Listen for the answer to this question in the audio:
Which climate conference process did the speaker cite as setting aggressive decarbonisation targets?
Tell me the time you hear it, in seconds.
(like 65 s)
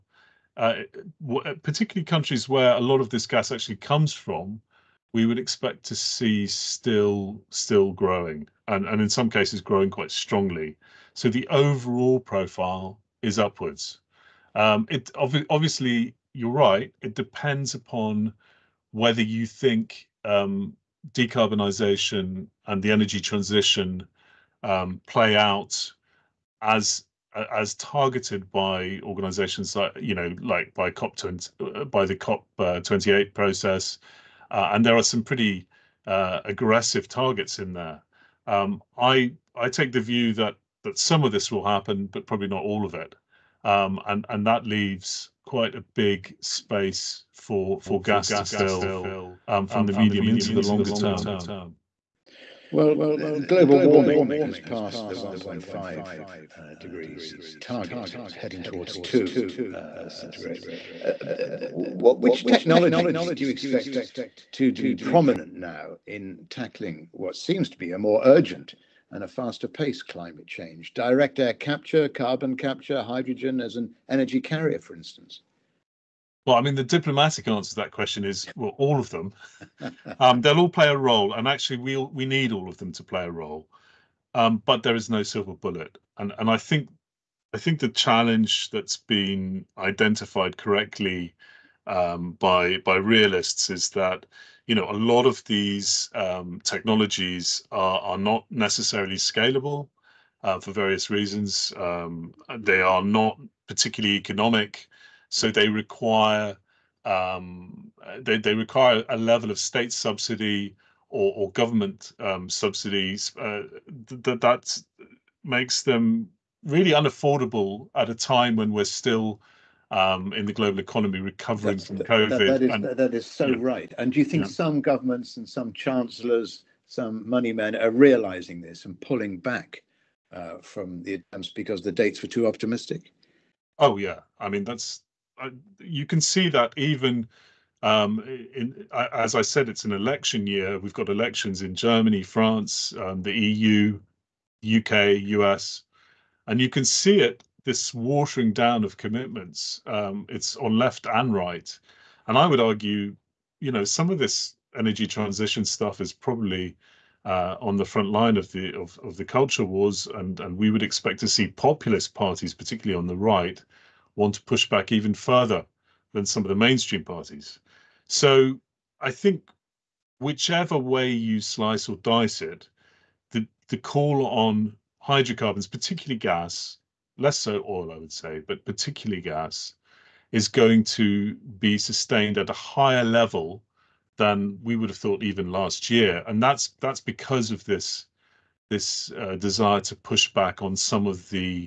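32 s.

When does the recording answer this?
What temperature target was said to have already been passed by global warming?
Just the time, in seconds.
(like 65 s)
55 s.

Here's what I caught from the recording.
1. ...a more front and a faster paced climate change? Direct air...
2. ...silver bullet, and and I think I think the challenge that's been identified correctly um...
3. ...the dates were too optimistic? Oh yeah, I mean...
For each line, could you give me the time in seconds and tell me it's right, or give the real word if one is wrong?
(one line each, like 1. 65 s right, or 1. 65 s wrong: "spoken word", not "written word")
1. 67 s wrong: "urgent", not "front"
2. 85 s right
3. 131 s right.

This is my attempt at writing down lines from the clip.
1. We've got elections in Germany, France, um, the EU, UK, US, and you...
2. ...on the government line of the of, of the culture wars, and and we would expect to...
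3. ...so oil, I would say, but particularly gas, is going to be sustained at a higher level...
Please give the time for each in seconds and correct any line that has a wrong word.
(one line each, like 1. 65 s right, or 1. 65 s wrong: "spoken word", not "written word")
1. 140 s right
2. 157 s wrong: "front", not "government"
3. 177 s right.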